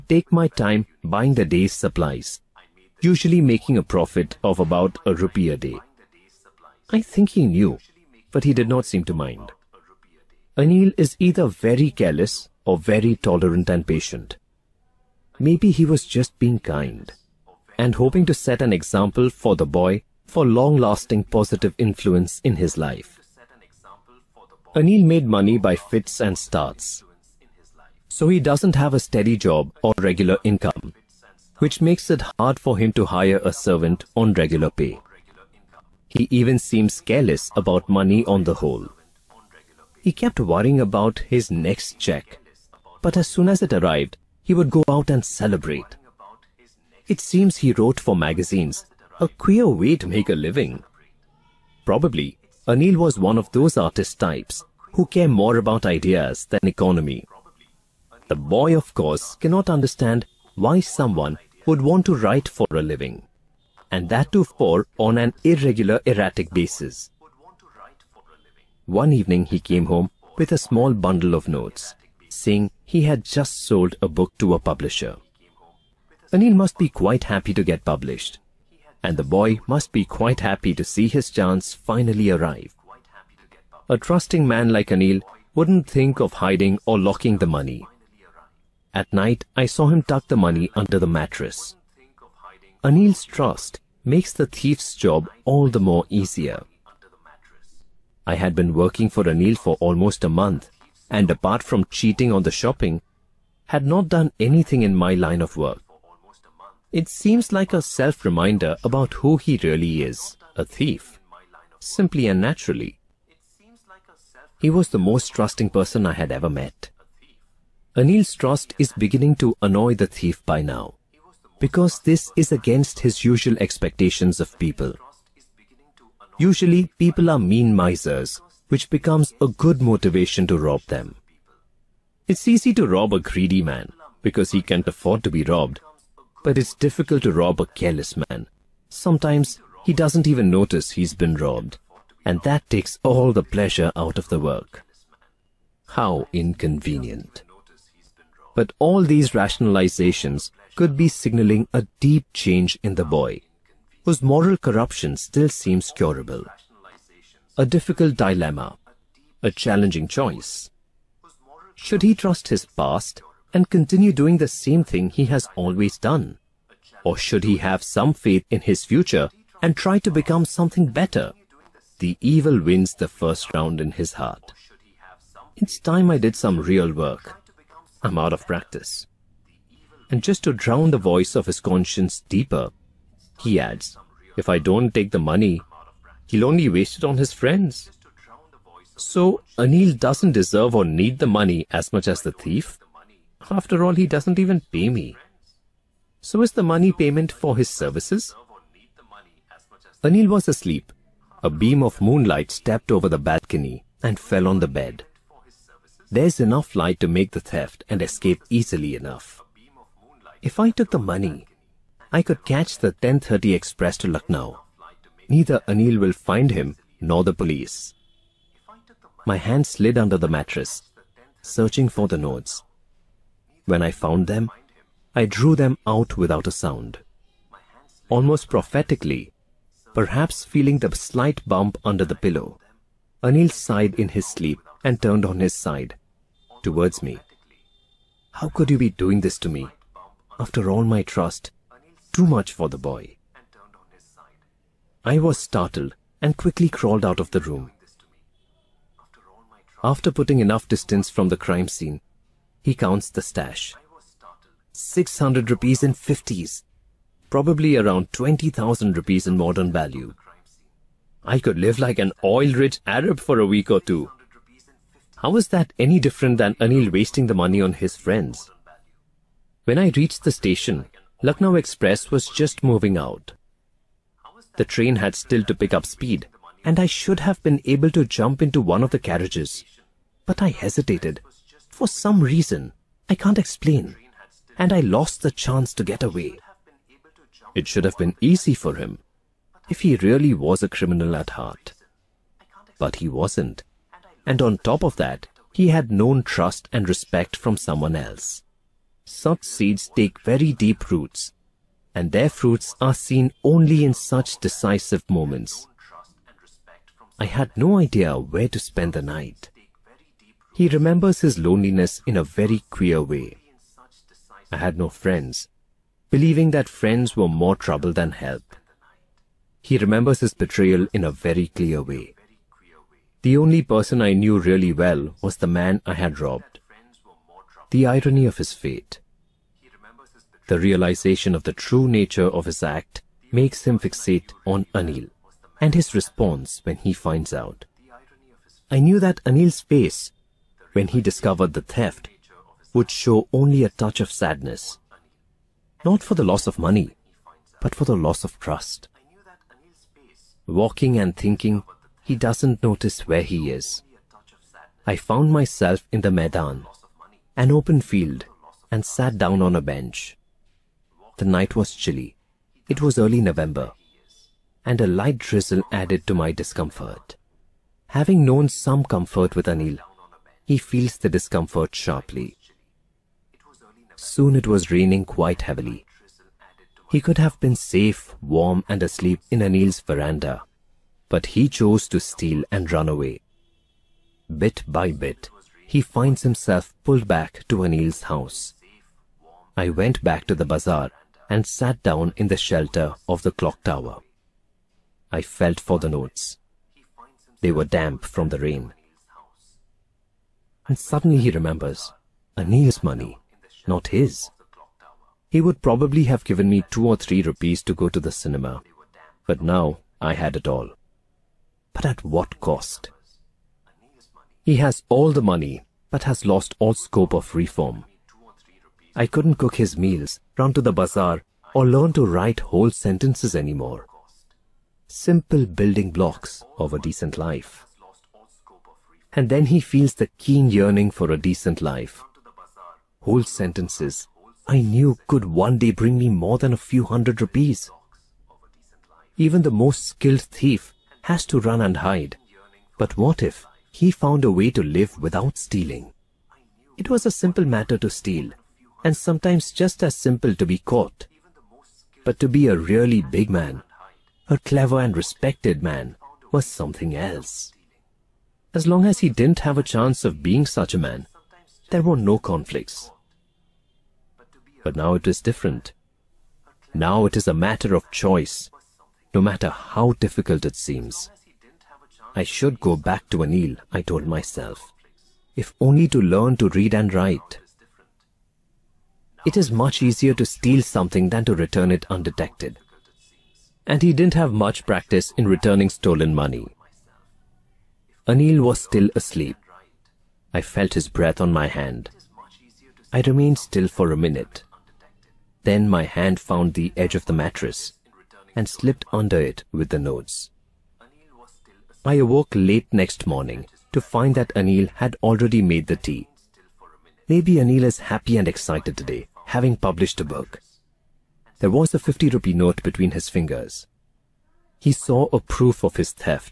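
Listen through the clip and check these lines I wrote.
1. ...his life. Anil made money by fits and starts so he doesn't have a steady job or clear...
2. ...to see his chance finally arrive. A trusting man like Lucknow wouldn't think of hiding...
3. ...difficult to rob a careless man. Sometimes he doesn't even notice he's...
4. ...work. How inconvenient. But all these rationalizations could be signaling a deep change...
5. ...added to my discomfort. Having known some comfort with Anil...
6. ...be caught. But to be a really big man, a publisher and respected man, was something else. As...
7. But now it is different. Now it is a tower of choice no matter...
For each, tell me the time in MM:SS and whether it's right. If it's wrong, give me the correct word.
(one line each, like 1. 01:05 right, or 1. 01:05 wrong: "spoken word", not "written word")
1. 00:22 wrong: "regular", not "clear"
2. 01:20 wrong: "Anil", not "Lucknow"
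3. 02:16 right
4. 02:24 right
5. 06:05 right
6. 07:30 wrong: "clever", not "publisher"
7. 07:44 wrong: "matter", not "tower".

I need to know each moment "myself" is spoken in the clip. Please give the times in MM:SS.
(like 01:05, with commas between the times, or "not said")
05:55, 07:54.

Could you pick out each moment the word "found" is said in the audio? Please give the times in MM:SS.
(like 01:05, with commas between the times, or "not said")
03:43, 05:54, 07:23, 08:16.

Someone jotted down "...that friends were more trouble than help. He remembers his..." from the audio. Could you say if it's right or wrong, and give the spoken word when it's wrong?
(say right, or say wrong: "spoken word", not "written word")
right.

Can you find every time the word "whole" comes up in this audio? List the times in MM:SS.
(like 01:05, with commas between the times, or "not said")
00:38, 07:02, 07:13.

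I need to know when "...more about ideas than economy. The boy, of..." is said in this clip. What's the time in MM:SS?
00:55.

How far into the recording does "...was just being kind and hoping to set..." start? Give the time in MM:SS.
00:15.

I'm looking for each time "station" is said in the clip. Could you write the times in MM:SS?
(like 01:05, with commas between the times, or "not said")
04:30.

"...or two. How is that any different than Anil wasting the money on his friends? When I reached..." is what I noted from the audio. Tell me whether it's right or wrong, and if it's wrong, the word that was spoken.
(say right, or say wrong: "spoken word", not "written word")
right.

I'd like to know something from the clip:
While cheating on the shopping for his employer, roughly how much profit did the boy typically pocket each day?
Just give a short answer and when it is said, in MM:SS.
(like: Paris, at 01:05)
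a rupee, at 00:05.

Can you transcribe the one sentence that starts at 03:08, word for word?
So Anil doesn't deserve or need the money as much as the thief.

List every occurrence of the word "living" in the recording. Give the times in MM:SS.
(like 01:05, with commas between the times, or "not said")
00:50, 01:02.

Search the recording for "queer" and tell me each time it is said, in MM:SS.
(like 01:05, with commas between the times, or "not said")
00:49, 05:12.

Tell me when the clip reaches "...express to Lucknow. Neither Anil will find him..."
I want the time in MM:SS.
03:33.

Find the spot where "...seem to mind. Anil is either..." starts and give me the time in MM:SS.
00:08.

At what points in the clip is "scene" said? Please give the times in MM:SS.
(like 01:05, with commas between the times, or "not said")
04:11.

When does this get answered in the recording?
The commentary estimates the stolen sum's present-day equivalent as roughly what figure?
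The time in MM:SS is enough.
04:18.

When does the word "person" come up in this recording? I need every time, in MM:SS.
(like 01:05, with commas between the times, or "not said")
01:55, 05:23.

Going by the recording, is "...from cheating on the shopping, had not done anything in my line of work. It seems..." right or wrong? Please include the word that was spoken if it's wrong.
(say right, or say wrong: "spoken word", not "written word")
right.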